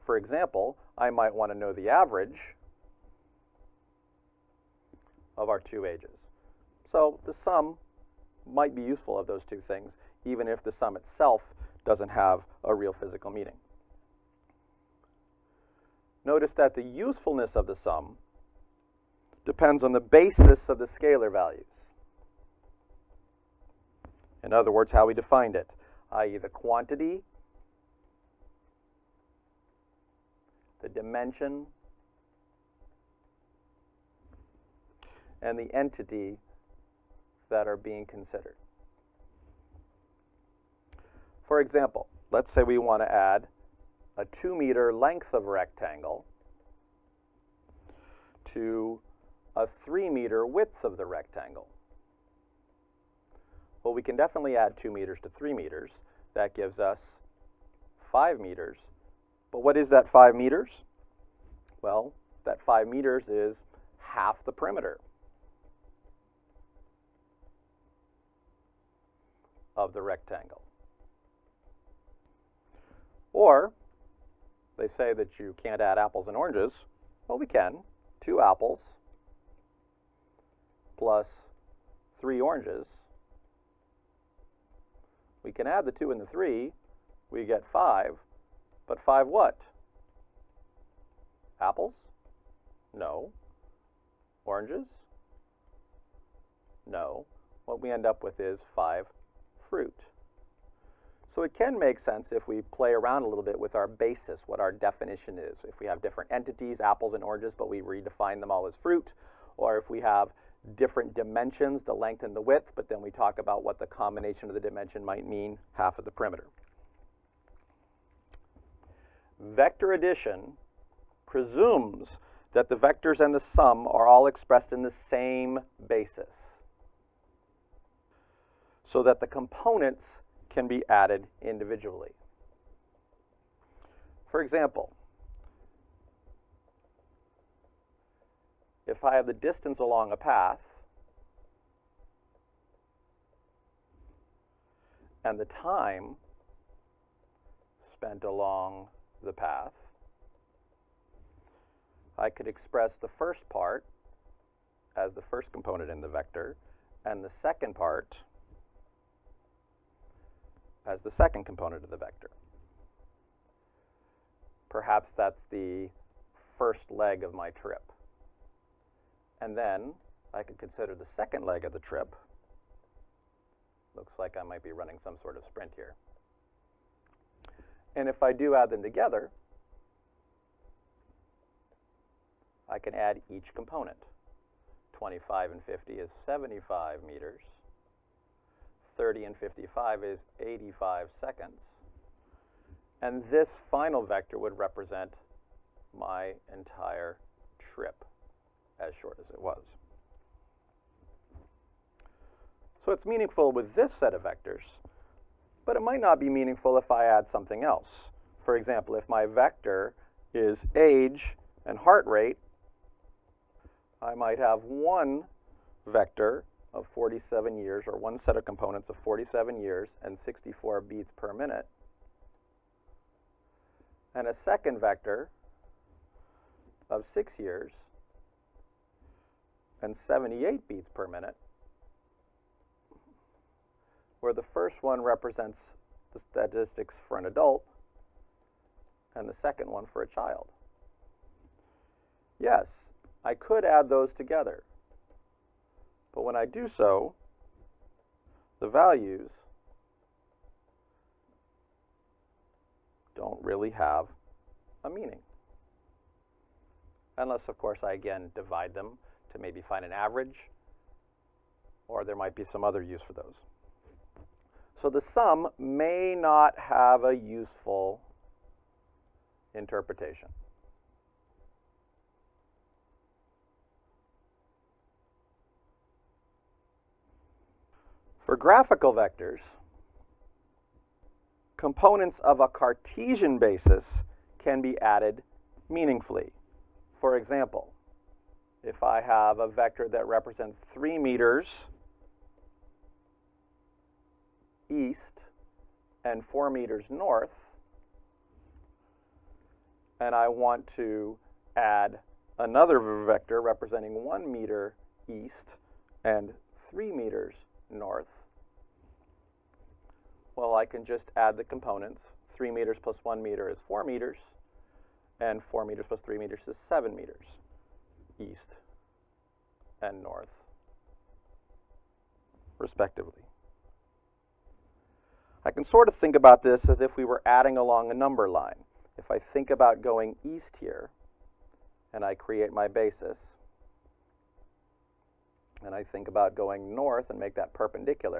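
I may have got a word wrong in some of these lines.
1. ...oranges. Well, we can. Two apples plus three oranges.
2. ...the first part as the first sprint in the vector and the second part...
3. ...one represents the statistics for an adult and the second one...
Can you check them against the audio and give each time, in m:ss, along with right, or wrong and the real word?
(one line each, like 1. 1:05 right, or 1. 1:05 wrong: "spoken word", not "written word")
1. 1:16 right
2. 2:32 wrong: "component", not "sprint"
3. 3:54 right.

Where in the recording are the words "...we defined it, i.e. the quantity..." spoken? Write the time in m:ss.
0:25.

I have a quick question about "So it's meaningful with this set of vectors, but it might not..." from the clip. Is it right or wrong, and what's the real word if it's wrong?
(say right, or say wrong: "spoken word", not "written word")
right.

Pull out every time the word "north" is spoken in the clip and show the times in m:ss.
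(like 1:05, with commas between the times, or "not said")
4:56, 5:07, 5:20, 5:36.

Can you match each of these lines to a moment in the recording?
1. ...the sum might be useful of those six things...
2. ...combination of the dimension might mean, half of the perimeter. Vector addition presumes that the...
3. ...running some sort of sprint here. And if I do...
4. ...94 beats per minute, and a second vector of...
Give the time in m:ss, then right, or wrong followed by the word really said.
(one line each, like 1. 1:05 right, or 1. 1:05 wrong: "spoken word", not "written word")
1. 0:07 wrong: "two", not "six"
2. 1:53 right
3. 2:54 right
4. 3:40 wrong: "64", not "94".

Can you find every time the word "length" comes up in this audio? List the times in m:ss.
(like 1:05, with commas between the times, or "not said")
0:44, 1:51.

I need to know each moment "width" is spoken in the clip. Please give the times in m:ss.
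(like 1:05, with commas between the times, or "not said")
0:50, 1:52.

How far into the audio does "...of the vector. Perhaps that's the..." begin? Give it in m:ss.
2:41.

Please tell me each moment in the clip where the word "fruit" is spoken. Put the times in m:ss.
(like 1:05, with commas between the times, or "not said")
1:39, 1:48.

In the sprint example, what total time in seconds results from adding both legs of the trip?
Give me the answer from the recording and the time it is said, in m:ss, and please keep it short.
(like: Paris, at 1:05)
85 seconds, at 3:10.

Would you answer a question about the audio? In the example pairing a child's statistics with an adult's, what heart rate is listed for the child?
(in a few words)
78 beats per minute.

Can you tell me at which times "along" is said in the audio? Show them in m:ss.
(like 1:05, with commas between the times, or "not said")
2:19, 2:28, 5:27.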